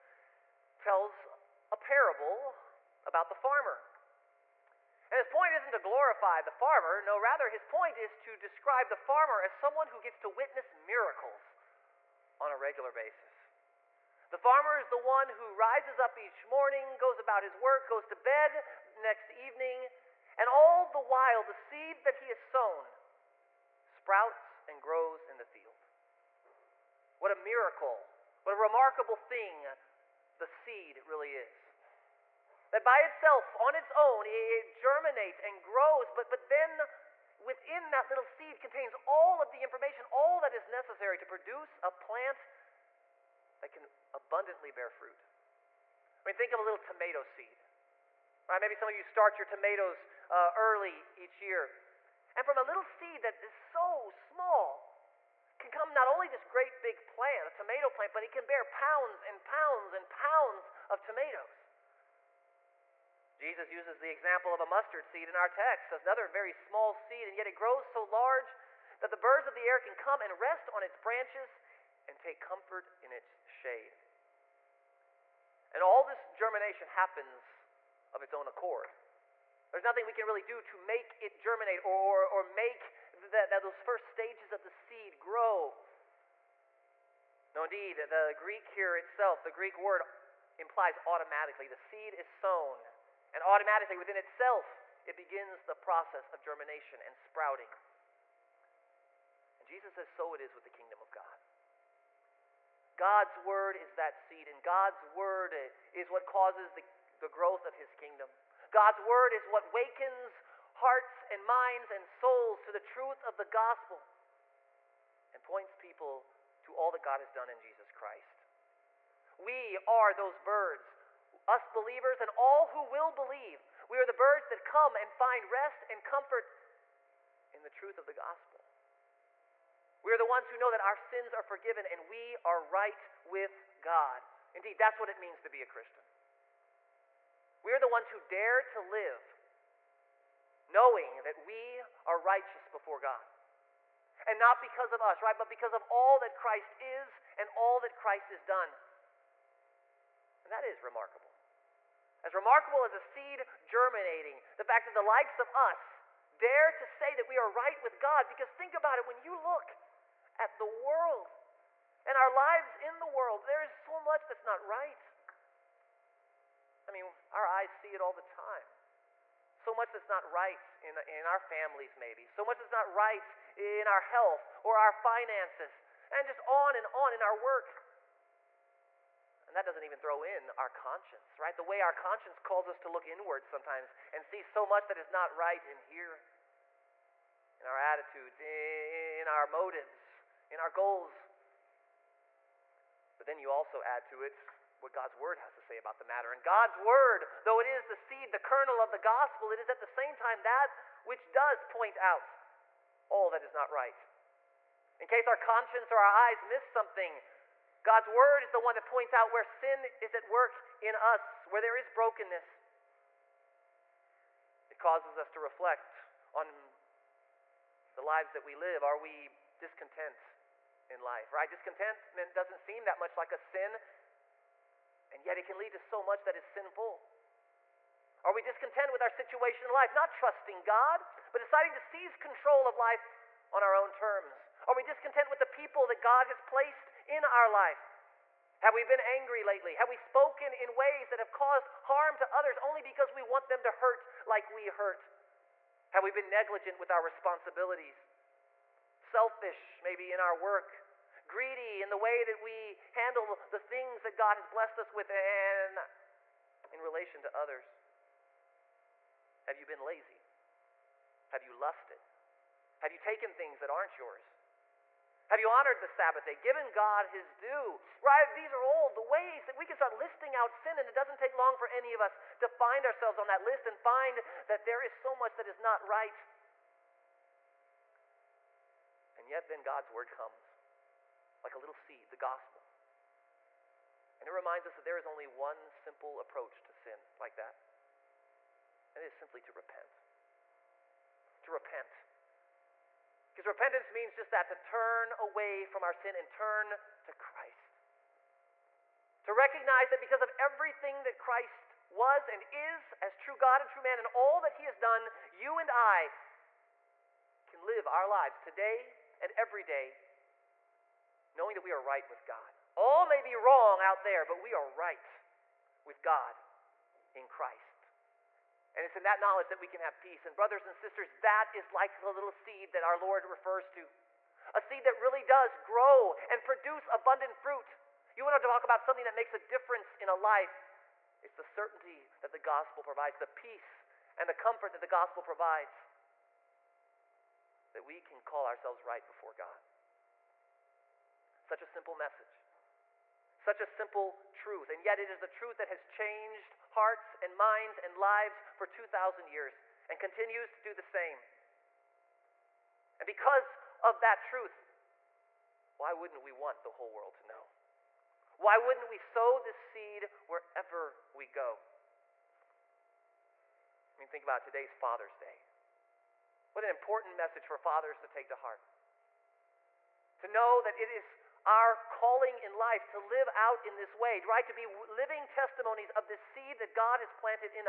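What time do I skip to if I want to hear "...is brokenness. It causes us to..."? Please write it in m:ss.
3:31.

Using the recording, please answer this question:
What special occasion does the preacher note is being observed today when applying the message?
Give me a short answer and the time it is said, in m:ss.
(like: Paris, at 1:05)
Father's Day, at 6:04.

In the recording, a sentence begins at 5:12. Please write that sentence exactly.
All may be wrong out there, but we are right with God in Christ.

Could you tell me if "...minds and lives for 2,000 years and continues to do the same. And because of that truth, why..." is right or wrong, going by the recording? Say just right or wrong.
right.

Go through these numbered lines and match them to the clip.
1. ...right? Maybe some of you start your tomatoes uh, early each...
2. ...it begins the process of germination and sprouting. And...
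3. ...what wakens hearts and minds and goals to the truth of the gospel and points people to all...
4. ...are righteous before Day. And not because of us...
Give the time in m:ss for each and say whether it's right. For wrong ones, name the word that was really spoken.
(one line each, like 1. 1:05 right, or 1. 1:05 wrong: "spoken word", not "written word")
1. 0:48 right
2. 1:35 right
3. 1:49 wrong: "souls", not "goals"
4. 2:22 wrong: "God", not "Day".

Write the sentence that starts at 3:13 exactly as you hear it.
But then you also add to it what God's word has to say about the matter.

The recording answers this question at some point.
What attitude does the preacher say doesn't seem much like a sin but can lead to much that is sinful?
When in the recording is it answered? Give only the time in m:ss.
3:41.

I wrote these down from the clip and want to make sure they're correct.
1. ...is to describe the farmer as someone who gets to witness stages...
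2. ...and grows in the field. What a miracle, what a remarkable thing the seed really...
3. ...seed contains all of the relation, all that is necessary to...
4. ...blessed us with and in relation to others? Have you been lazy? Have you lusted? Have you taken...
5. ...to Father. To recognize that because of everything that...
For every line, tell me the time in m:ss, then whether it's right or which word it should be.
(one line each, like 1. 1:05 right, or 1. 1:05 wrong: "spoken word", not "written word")
1. 0:07 wrong: "miracles", not "stages"
2. 0:24 right
3. 0:38 wrong: "information", not "relation"
4. 4:14 right
5. 4:57 wrong: "Christ", not "Father".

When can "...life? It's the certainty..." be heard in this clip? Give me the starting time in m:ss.
5:30.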